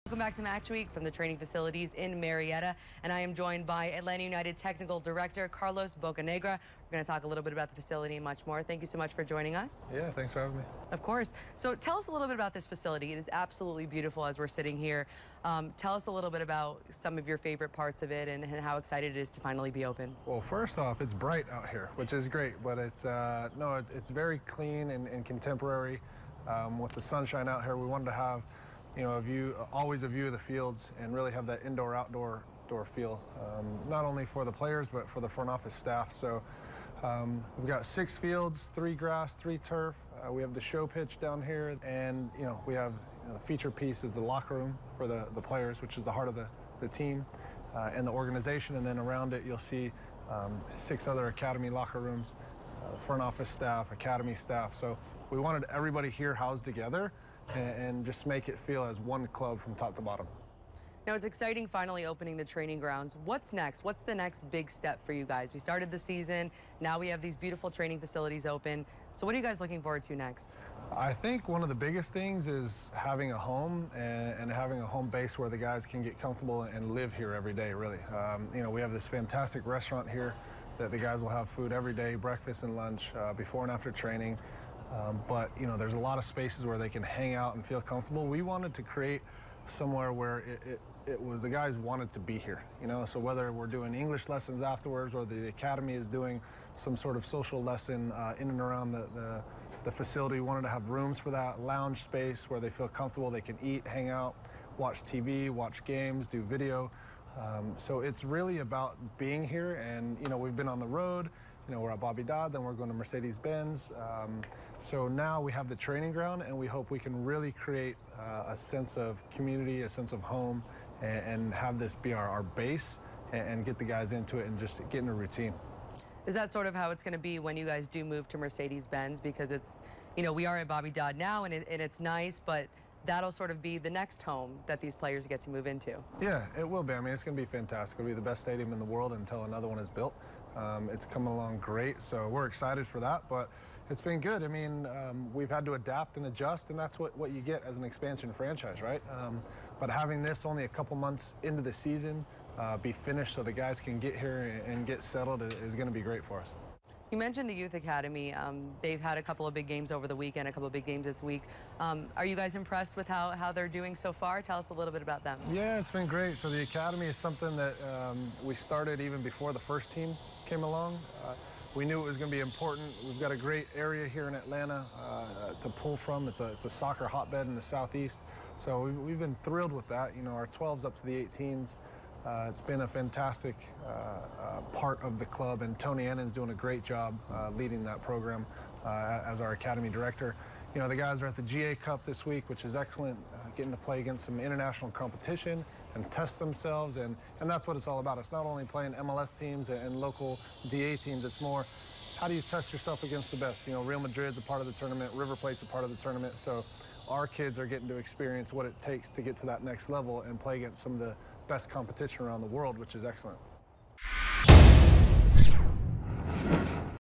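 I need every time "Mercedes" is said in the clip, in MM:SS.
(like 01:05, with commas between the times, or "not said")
01:52, 02:08.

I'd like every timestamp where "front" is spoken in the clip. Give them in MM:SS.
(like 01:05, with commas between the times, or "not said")
00:35, 00:52.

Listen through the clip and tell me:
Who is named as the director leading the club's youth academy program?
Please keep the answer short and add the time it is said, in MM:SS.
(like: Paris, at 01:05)
Tony Annan, at 03:05.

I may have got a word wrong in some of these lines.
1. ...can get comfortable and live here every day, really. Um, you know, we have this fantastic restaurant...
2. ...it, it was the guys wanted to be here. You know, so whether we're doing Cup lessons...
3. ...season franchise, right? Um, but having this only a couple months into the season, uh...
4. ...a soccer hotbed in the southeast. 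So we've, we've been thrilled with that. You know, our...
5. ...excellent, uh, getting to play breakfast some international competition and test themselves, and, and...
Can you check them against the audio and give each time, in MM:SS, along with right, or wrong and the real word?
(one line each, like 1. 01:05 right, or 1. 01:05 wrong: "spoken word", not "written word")
1. 01:15 right
2. 01:30 wrong: "English", not "Cup"
3. 02:27 wrong: "expansion", not "season"
4. 02:56 right
5. 03:12 wrong: "against", not "breakfast".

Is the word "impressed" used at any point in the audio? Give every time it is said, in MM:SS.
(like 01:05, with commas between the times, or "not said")
02:42.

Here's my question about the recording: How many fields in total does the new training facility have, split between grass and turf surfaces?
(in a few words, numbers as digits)
6.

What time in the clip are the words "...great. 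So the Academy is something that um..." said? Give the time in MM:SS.
02:46.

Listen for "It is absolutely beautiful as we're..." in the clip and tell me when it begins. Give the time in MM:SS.
00:13.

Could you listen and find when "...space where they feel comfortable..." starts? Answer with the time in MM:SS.
01:42.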